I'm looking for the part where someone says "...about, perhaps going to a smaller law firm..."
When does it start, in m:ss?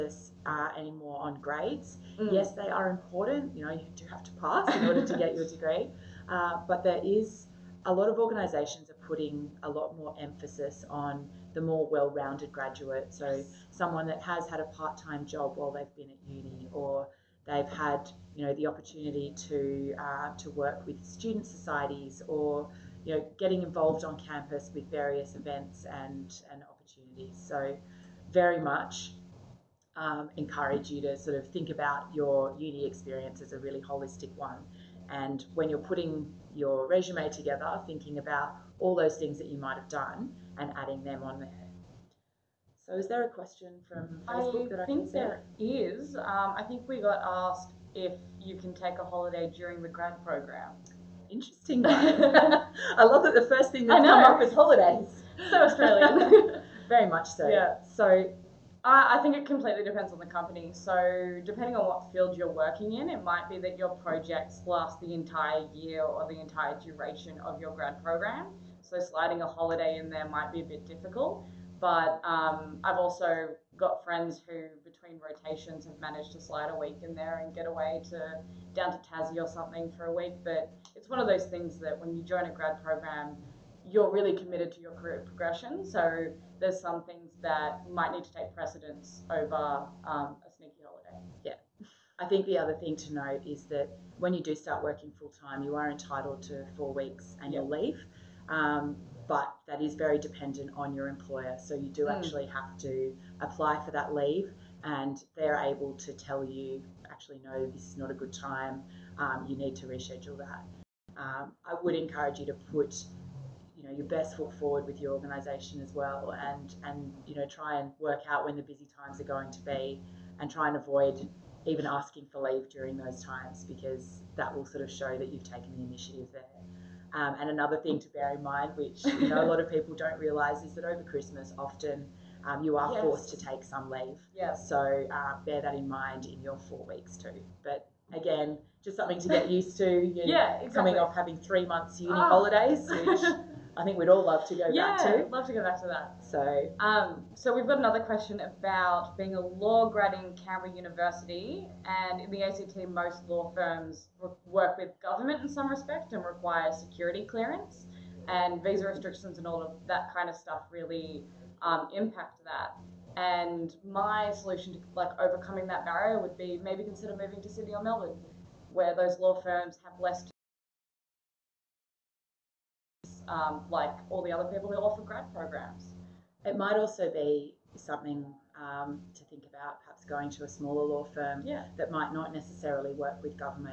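2:59.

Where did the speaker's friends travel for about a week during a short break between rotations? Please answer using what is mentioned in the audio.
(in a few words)
Tassie.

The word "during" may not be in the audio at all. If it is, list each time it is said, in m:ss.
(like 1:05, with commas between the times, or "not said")
0:49, 2:02.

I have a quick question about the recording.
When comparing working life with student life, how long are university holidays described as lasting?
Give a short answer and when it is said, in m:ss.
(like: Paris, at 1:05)
3 months, at 2:21.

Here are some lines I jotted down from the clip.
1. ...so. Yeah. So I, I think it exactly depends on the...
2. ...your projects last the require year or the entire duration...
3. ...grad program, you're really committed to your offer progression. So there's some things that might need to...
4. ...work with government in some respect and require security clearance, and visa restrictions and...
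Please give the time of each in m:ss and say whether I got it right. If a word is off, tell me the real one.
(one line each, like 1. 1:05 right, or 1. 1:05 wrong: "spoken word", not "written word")
1. 0:57 wrong: "completely", not "exactly"
2. 1:03 wrong: "entire", not "require"
3. 1:22 wrong: "career", not "offer"
4. 2:34 right.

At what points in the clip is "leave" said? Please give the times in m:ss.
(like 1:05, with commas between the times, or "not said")
1:37, 1:44, 2:02, 2:13.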